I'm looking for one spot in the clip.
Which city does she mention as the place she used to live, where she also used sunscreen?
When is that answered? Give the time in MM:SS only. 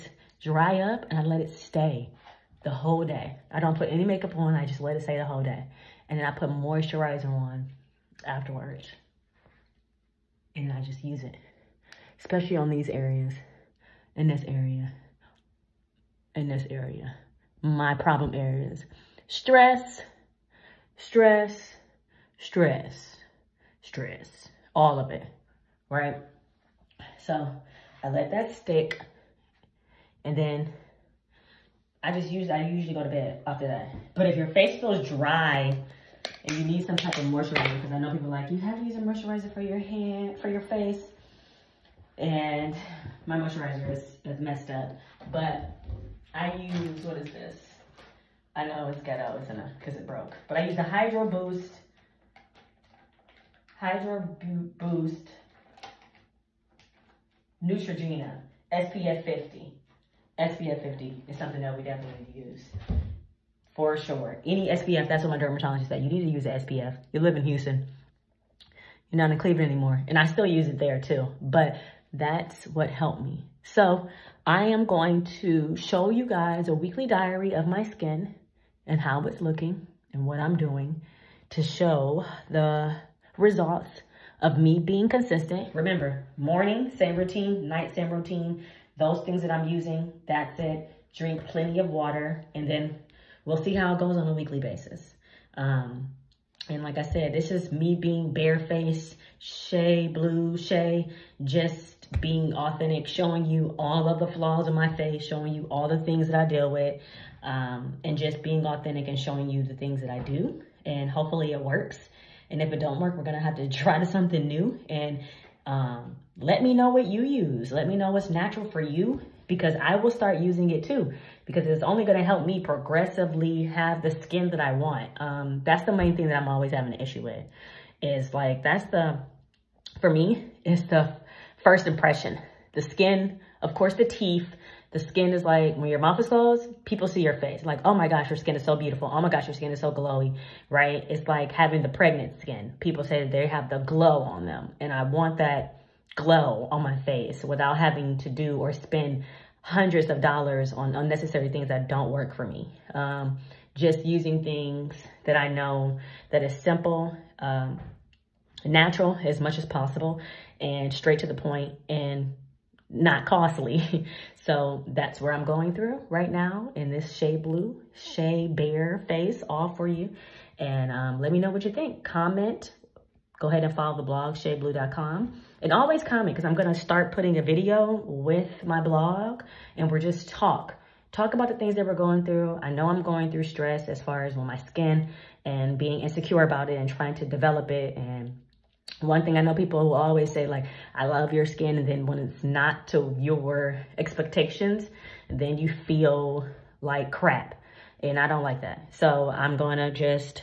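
01:09.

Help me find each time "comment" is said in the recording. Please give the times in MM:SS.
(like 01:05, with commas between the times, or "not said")
02:52, 02:56.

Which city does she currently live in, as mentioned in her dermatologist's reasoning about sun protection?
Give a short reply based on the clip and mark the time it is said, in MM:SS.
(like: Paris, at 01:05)
Houston, at 01:07.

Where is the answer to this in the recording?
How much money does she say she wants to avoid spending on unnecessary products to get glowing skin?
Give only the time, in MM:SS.
02:29.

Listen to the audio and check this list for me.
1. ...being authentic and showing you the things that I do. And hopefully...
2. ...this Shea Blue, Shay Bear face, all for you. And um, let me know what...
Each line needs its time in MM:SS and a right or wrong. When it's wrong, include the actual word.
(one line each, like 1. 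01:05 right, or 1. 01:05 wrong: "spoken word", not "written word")
1. 01:48 right
2. 02:46 right.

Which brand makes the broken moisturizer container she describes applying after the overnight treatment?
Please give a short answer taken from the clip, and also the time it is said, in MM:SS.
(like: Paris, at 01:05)
Neutrogena, at 00:57.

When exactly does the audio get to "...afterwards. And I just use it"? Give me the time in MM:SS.
00:08.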